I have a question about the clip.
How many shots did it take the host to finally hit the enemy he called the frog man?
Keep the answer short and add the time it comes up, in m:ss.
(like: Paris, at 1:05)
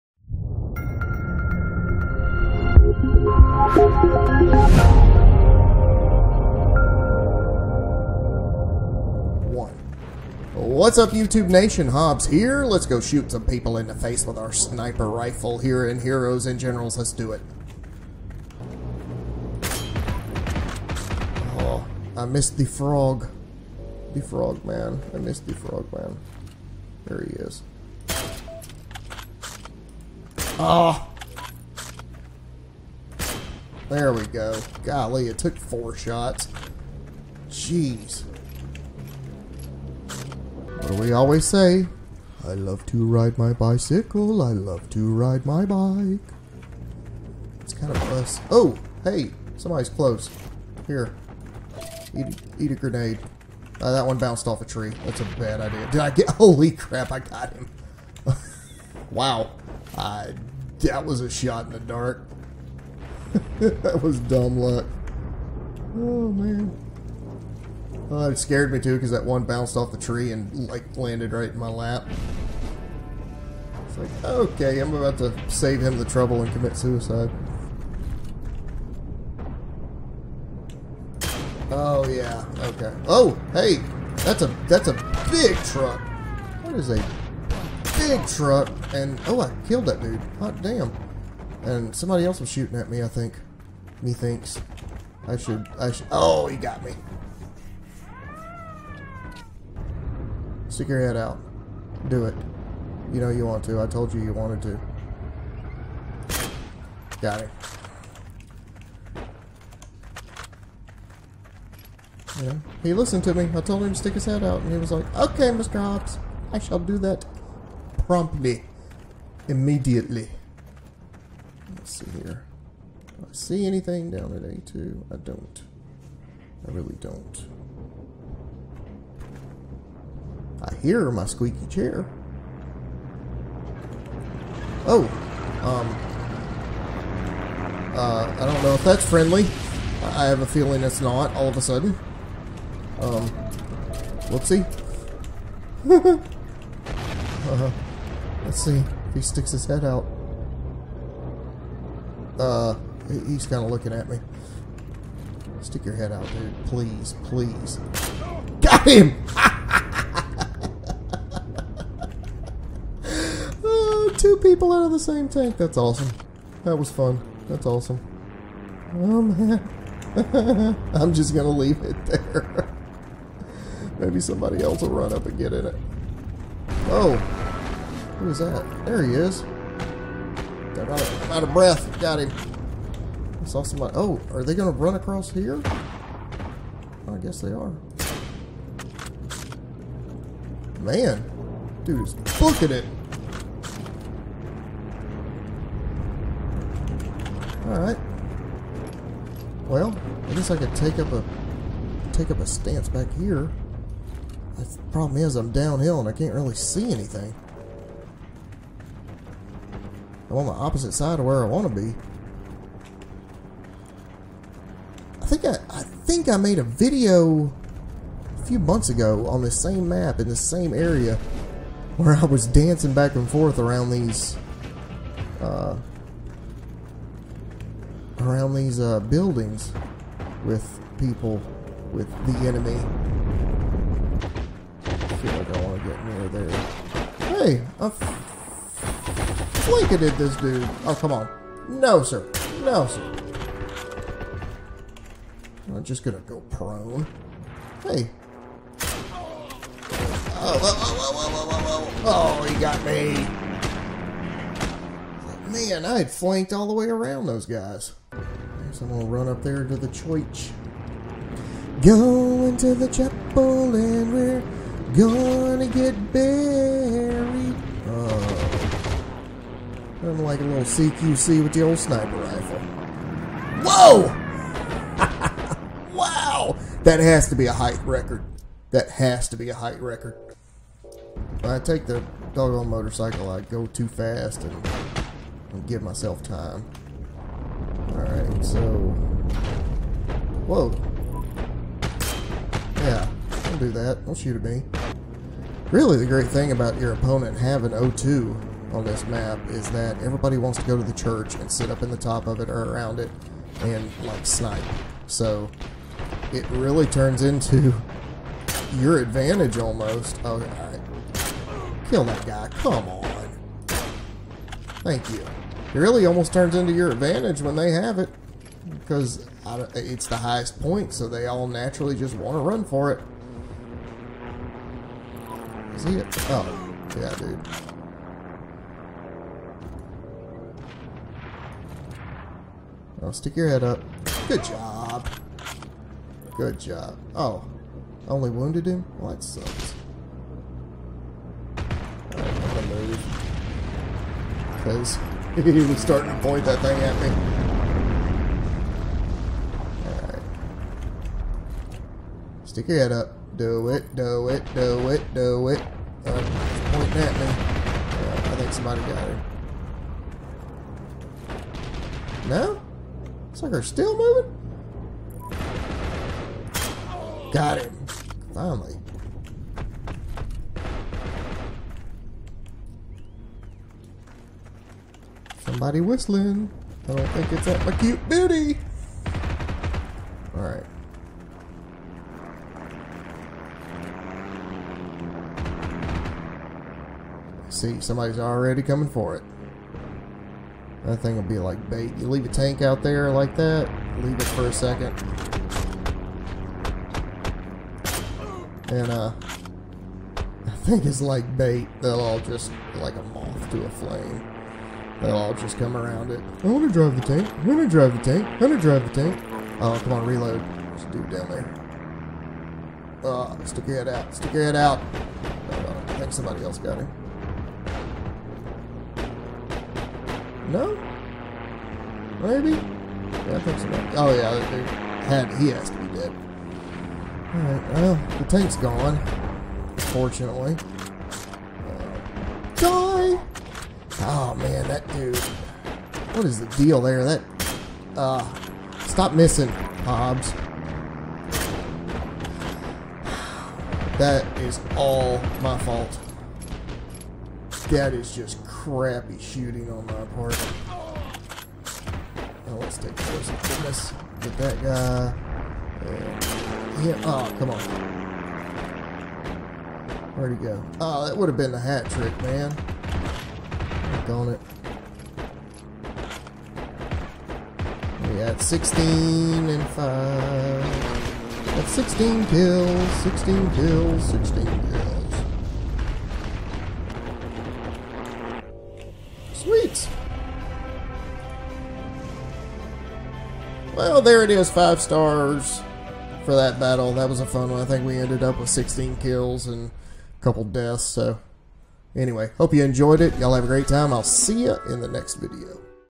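4, at 0:35.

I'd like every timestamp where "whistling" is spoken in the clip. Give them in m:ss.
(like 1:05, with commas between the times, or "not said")
6:15.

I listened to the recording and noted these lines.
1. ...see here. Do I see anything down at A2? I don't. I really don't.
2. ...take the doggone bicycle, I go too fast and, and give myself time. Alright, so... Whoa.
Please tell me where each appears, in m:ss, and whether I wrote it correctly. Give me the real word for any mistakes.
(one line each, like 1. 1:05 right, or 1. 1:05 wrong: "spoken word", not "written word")
1. 2:01 right
2. 4:41 wrong: "motorcycle", not "bicycle".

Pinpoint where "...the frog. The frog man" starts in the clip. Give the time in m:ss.
0:22.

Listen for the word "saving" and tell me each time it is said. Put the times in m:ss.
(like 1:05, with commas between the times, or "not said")
not said.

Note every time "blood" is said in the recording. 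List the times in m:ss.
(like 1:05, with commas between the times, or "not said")
not said.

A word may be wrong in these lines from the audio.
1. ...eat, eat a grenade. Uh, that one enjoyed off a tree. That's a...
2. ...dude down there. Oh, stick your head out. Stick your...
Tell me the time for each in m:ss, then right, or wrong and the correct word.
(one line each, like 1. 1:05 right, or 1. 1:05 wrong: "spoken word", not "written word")
1. 0:52 wrong: "bounced", not "enjoyed"
2. 6:50 right.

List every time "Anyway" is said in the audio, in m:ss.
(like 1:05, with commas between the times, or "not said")
8:11.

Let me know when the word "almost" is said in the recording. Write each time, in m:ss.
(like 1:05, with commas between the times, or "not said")
5:09, 5:16.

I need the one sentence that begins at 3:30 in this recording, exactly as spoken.
I'm on the opposite side of where I want to be.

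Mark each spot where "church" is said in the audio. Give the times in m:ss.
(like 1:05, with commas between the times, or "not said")
4:19, 5:00.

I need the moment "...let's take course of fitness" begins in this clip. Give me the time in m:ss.
7:32.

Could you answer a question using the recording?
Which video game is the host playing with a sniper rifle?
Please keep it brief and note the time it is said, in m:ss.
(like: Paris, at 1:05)
Heroes and Generals, at 0:16.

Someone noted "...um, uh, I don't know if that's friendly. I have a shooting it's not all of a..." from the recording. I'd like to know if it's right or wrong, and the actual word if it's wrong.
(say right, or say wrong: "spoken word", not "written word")
wrong: "feeling", not "shooting".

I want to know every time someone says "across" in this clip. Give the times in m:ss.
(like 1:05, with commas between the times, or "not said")
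3:04.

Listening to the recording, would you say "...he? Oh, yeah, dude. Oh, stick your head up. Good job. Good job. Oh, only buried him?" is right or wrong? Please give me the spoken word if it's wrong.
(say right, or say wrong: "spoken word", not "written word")
wrong: "wounded", not "buried".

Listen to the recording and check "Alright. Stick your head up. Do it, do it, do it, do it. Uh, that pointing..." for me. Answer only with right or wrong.
right.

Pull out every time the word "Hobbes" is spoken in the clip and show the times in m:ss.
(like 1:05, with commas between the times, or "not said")
0:11, 1:55, 7:19.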